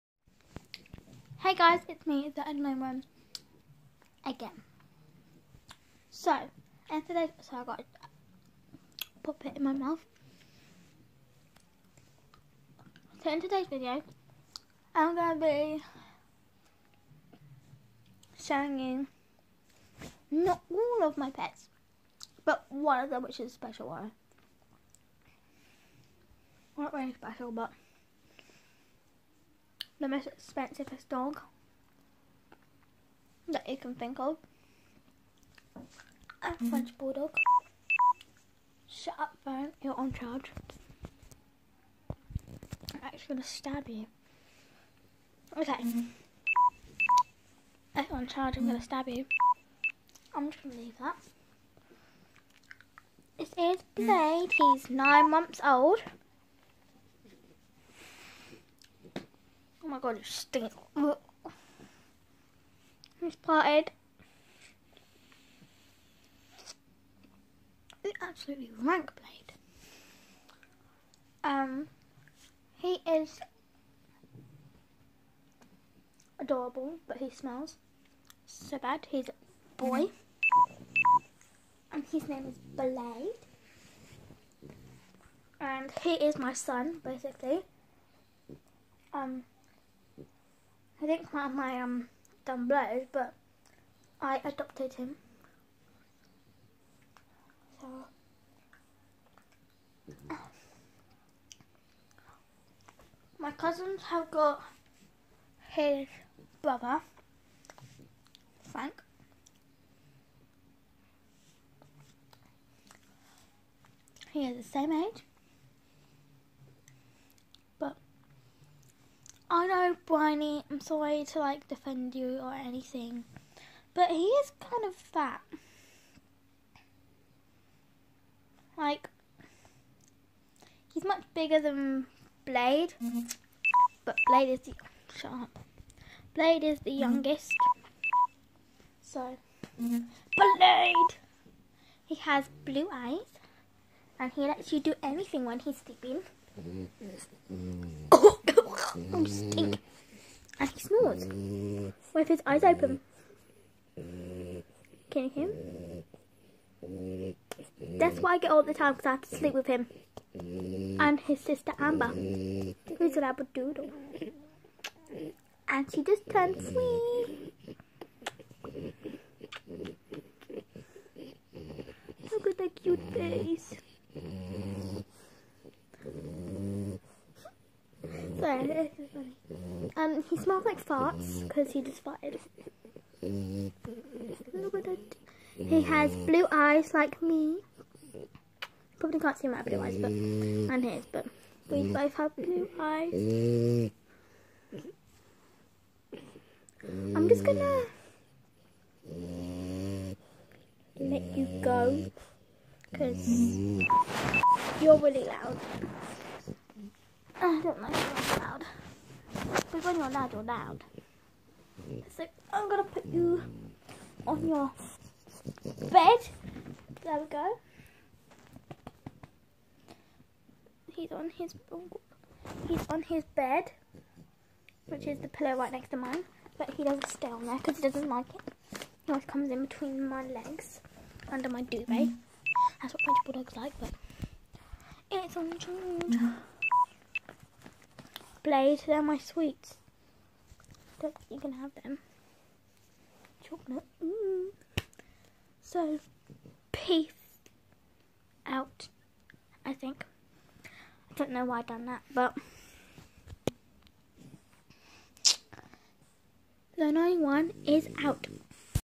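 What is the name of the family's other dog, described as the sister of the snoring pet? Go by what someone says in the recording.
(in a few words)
Amber.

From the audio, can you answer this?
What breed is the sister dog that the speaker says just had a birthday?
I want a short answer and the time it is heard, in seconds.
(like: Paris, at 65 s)
Labradoodle, at 163 s.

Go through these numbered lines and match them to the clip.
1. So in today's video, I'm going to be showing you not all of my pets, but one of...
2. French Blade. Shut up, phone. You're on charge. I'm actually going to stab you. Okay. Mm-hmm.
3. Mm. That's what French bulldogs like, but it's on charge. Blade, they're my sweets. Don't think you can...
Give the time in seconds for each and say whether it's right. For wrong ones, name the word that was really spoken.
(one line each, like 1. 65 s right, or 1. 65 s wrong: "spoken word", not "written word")
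1. 13 s right
2. 36 s wrong: "Bulldog", not "Blade"
3. 231 s right.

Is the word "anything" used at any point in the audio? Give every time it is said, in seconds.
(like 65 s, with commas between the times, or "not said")
122 s, 145 s.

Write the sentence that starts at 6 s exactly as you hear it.
So, and today, so I got to pop it in my mouth.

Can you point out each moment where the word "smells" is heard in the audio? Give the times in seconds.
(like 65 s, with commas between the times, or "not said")
77 s, 180 s.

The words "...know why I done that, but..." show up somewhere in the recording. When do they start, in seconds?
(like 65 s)
251 s.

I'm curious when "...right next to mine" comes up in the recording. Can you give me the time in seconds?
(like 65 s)
225 s.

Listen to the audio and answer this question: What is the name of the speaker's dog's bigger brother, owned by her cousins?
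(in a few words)
Frank.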